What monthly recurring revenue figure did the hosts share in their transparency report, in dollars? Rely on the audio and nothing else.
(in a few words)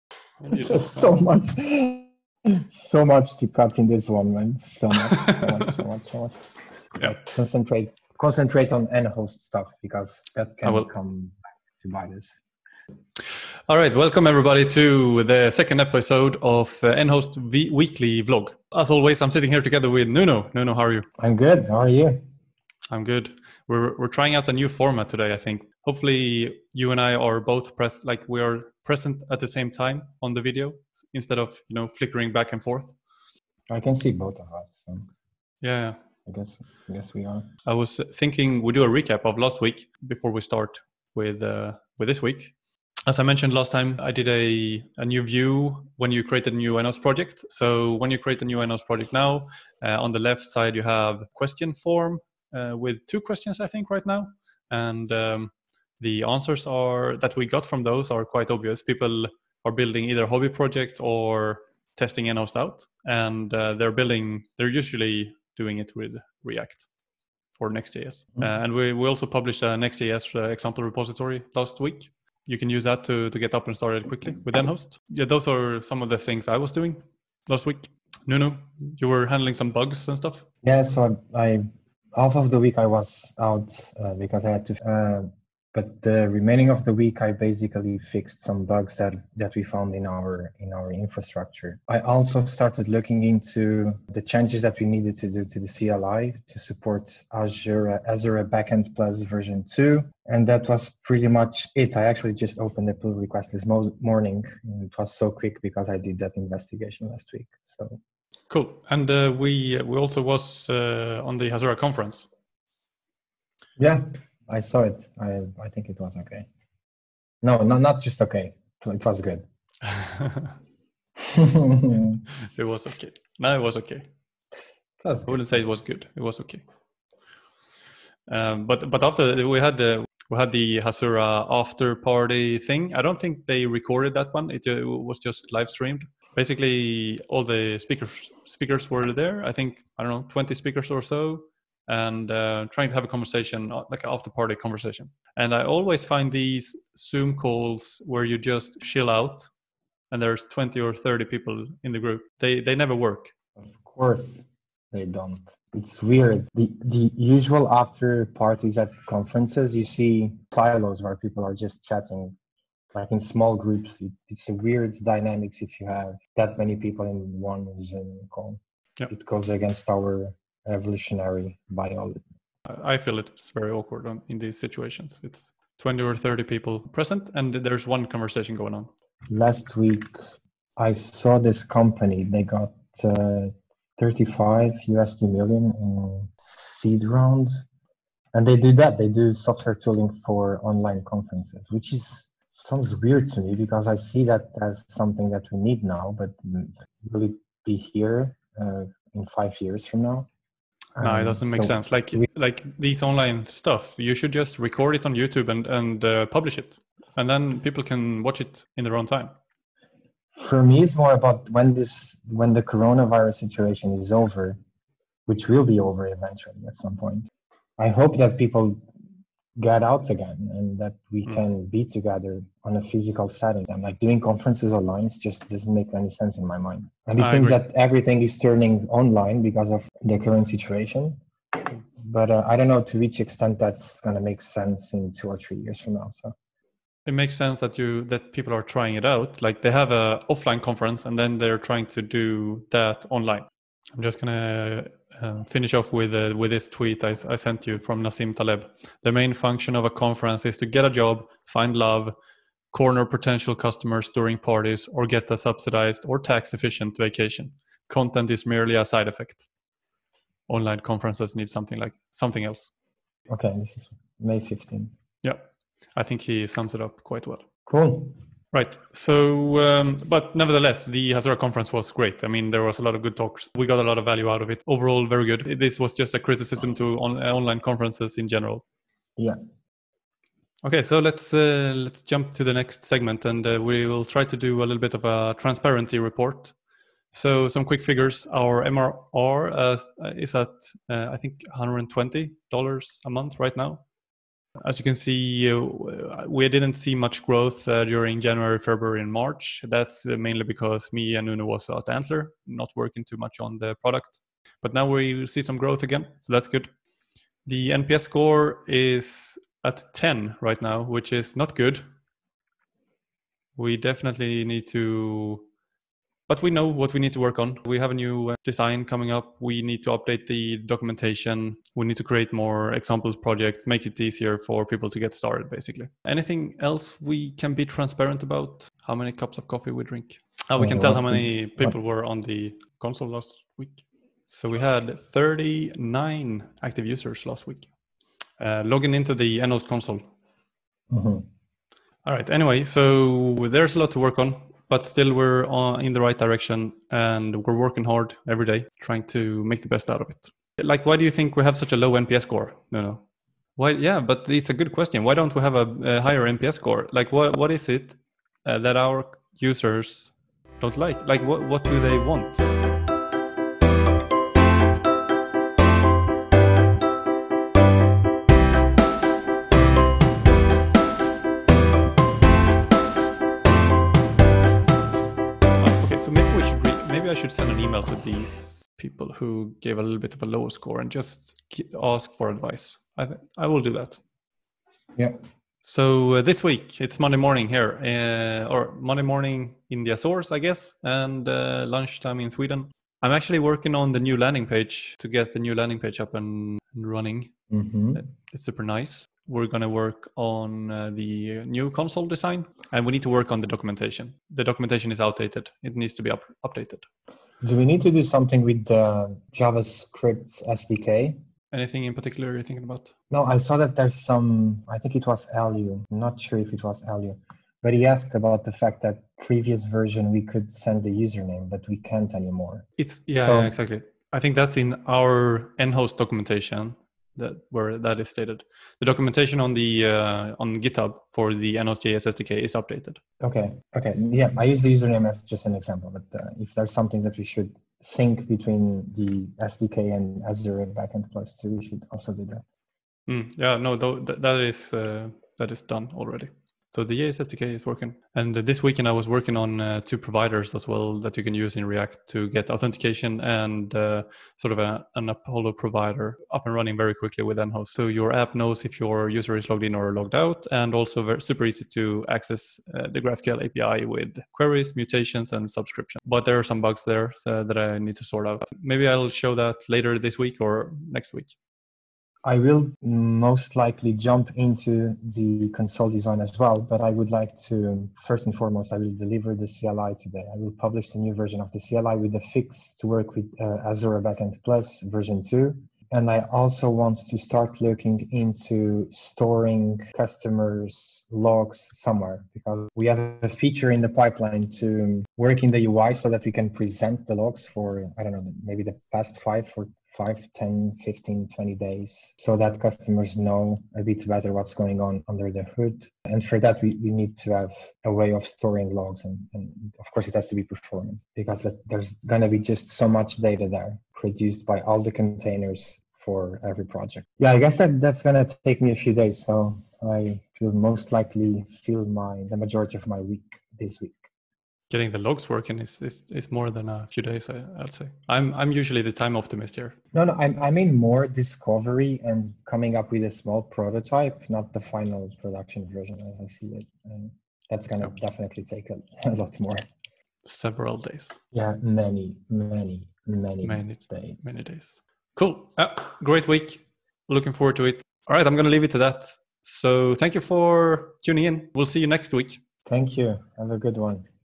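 120.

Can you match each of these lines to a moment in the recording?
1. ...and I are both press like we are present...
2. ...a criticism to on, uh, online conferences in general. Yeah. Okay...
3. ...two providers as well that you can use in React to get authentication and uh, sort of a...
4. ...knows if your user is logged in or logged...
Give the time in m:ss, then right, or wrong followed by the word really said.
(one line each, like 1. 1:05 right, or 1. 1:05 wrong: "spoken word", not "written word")
1. 0:26 right
2. 4:36 right
3. 7:29 right
4. 7:38 right.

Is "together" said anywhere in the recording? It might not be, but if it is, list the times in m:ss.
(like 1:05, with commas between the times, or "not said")
0:19, 3:41.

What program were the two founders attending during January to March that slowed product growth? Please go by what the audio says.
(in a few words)
Antler.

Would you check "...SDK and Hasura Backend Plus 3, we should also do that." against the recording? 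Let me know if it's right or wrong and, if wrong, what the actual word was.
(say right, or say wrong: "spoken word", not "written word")
wrong: "2", not "3".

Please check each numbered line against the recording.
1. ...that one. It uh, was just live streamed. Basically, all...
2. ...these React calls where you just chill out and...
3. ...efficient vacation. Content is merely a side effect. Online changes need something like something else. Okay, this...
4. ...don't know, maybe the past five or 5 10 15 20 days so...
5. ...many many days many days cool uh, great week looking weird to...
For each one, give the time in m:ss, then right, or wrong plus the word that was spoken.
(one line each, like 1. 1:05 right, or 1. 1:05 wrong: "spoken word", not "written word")
1. 2:14 right
2. 2:26 wrong: "Zoom", not "React"
3. 4:16 wrong: "conferences", not "changes"
4. 8:18 right
5. 9:03 wrong: "forward", not "weird".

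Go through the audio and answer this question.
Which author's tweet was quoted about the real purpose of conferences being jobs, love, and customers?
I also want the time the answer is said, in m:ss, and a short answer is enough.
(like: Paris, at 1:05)
Nassim Taleb, at 4:08.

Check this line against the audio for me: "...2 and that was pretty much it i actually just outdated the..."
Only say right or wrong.
wrong.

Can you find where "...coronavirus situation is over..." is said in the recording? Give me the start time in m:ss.
3:32.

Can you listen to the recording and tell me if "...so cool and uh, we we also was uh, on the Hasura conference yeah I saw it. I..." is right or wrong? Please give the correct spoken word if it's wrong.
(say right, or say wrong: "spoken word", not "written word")
right.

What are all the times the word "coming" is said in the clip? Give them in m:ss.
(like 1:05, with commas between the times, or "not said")
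5:18, 8:52.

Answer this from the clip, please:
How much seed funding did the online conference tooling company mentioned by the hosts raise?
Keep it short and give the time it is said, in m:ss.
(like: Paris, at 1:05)
35 million USD, at 3:03.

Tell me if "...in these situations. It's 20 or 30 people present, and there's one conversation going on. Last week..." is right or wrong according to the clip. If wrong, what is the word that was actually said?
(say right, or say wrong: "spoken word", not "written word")
right.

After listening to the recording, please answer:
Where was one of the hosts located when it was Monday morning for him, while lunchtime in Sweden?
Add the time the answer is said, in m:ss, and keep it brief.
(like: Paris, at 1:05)
Azores, at 6:29.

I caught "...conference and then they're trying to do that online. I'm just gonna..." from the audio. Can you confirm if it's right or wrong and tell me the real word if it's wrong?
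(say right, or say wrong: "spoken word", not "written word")
right.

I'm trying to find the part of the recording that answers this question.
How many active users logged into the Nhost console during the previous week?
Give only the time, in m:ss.
5:35.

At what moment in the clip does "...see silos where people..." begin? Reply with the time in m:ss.
2:39.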